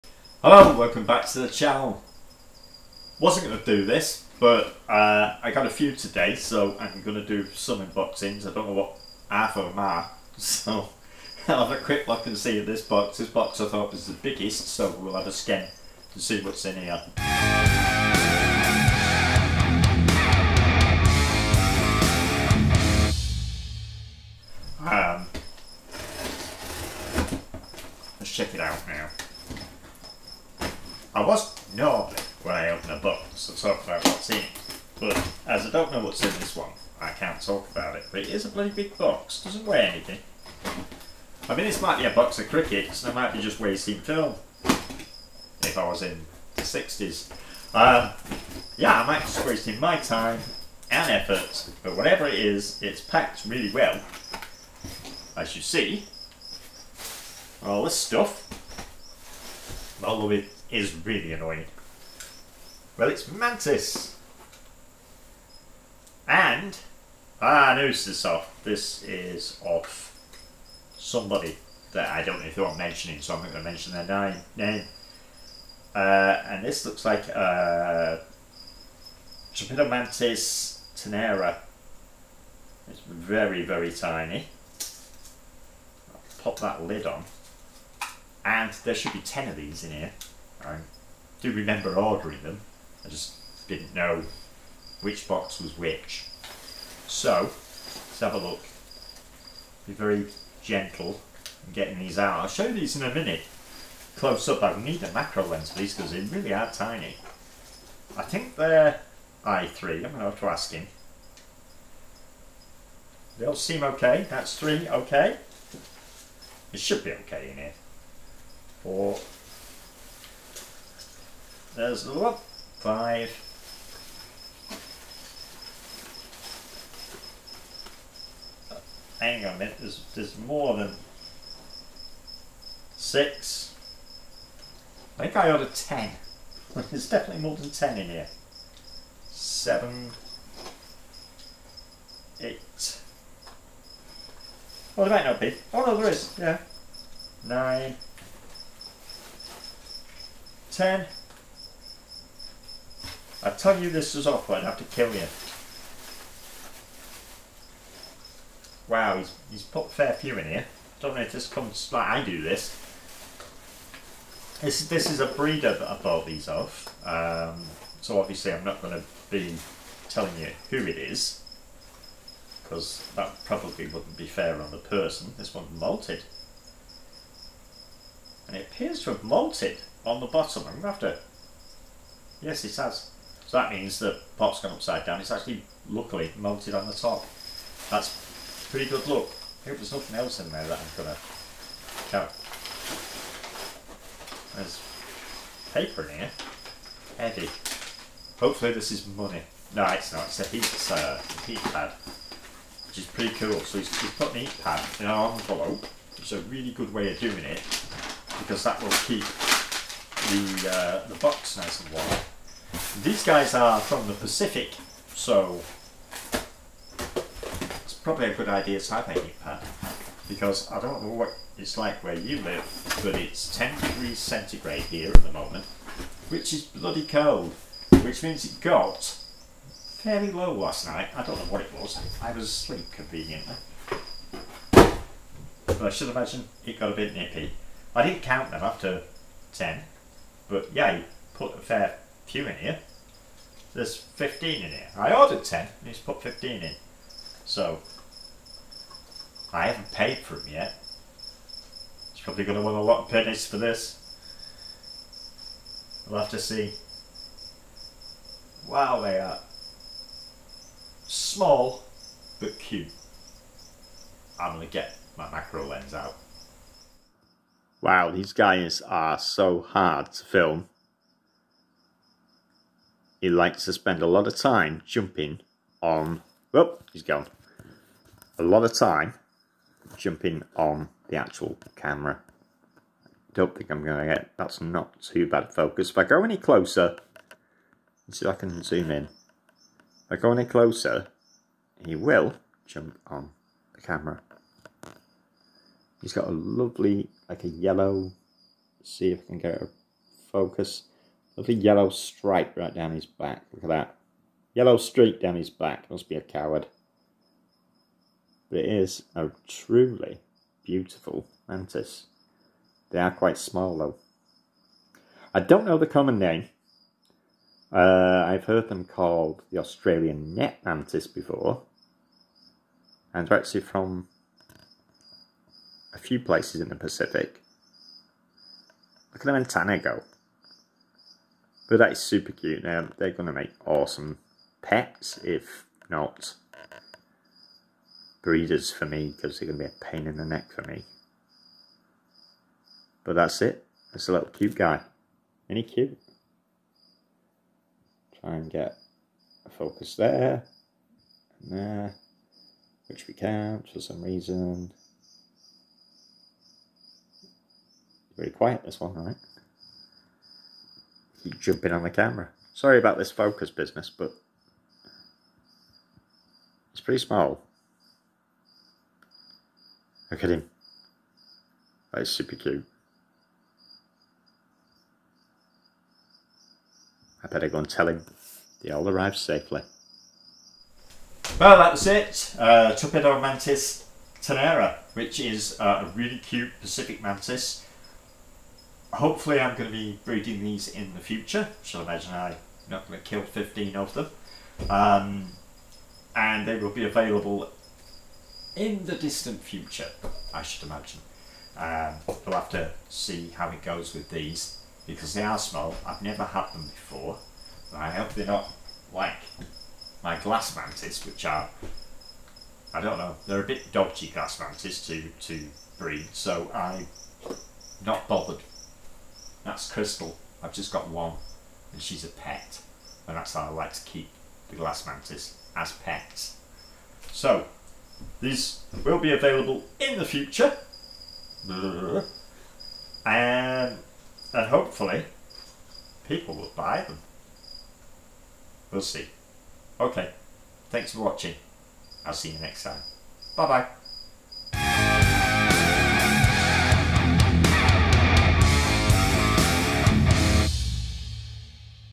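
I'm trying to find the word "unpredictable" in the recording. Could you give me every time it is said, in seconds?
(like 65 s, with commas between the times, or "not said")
not said.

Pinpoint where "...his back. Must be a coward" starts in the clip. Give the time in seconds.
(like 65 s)
305 s.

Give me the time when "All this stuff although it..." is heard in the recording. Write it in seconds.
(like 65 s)
57 s.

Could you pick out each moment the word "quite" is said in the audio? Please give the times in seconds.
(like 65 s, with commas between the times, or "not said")
313 s.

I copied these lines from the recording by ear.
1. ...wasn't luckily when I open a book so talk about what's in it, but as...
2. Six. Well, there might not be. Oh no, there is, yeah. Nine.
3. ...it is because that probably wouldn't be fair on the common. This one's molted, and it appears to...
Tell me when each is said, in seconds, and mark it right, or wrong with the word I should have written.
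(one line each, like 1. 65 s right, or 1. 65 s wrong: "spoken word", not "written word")
1. 31 s wrong: "normally", not "luckily"
2. 142 s wrong: "Eight", not "Six"
3. 170 s wrong: "person", not "common".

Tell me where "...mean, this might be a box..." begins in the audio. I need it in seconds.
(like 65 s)
41 s.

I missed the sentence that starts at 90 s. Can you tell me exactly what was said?
I do remember ordering them, I just didn't know which box was which.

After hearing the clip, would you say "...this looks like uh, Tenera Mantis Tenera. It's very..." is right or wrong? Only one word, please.
wrong.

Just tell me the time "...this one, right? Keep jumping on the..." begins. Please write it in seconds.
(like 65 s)
358 s.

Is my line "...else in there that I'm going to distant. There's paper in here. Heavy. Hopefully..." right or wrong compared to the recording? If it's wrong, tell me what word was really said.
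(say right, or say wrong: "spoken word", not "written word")
wrong: "count", not "distant".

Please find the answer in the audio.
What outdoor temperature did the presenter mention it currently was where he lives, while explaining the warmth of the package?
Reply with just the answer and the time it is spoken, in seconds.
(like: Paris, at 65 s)
10 degrees centigrade, at 223 s.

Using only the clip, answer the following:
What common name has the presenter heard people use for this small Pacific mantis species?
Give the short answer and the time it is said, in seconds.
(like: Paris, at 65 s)
Australian net mantis, at 319 s.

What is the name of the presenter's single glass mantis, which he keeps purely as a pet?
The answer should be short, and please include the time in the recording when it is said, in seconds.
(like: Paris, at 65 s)
Crystal, at 419 s.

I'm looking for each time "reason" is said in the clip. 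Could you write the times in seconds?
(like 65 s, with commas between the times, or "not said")
354 s.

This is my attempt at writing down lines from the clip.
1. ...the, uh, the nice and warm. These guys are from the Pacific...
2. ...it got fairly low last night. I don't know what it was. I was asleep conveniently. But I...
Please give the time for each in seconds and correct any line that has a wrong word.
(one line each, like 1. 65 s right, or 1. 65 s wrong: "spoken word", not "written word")
1. 210 s right
2. 228 s right.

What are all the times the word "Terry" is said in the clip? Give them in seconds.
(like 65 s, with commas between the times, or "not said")
not said.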